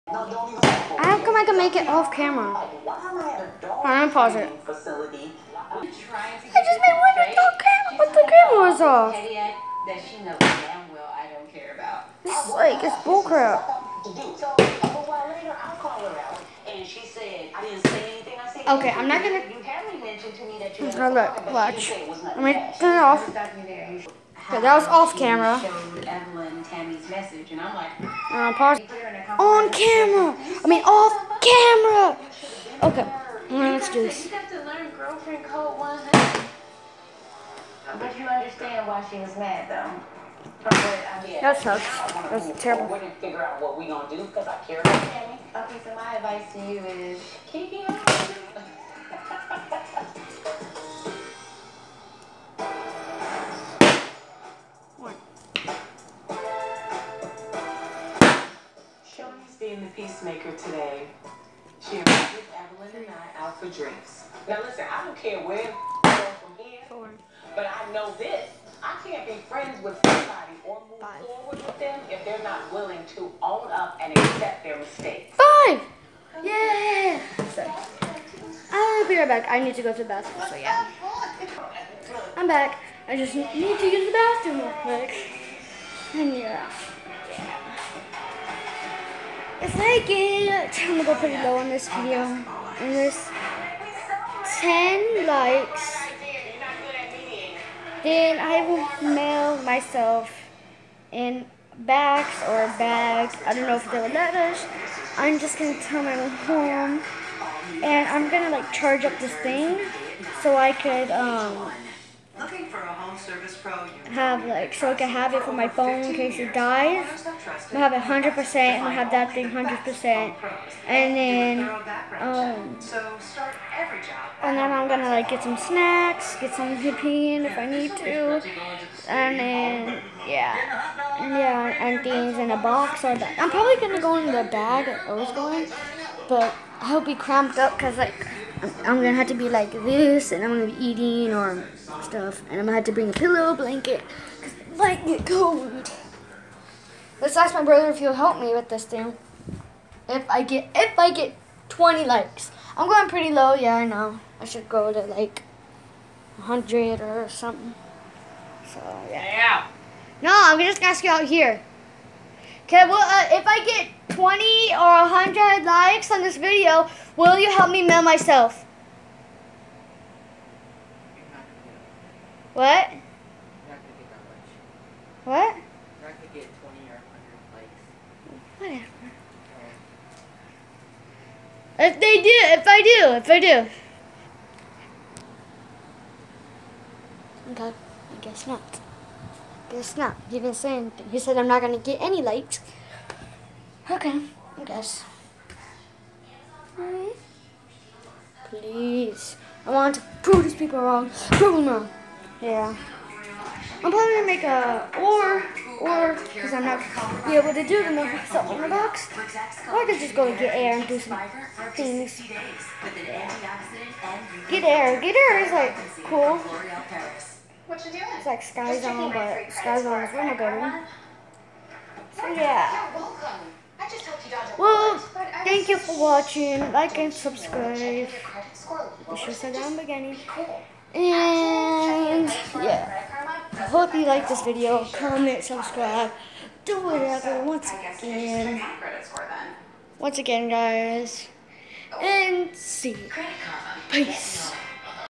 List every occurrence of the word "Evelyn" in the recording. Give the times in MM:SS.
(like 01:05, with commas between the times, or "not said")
00:26, 01:02.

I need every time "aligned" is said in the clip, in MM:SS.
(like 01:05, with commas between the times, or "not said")
not said.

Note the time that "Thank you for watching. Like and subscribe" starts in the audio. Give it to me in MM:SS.
03:45.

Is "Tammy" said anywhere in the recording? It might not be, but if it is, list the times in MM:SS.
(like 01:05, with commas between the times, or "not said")
00:26, 00:45.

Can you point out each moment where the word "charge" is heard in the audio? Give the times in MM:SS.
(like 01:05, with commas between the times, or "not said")
01:48.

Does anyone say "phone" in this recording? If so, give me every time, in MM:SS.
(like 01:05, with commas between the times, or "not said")
01:55.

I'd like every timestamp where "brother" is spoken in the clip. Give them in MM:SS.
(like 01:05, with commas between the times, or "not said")
02:27.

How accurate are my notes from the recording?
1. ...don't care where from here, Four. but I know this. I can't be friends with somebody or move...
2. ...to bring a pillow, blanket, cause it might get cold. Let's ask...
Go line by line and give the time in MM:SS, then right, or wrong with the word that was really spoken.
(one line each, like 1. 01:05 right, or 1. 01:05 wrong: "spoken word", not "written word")
1. 01:05 right
2. 02:22 right.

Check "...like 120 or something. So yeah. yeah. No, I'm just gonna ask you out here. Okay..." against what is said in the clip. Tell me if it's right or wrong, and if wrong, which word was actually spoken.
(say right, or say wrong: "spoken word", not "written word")
wrong: "100", not "120".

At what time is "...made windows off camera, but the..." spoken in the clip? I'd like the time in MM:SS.
00:06.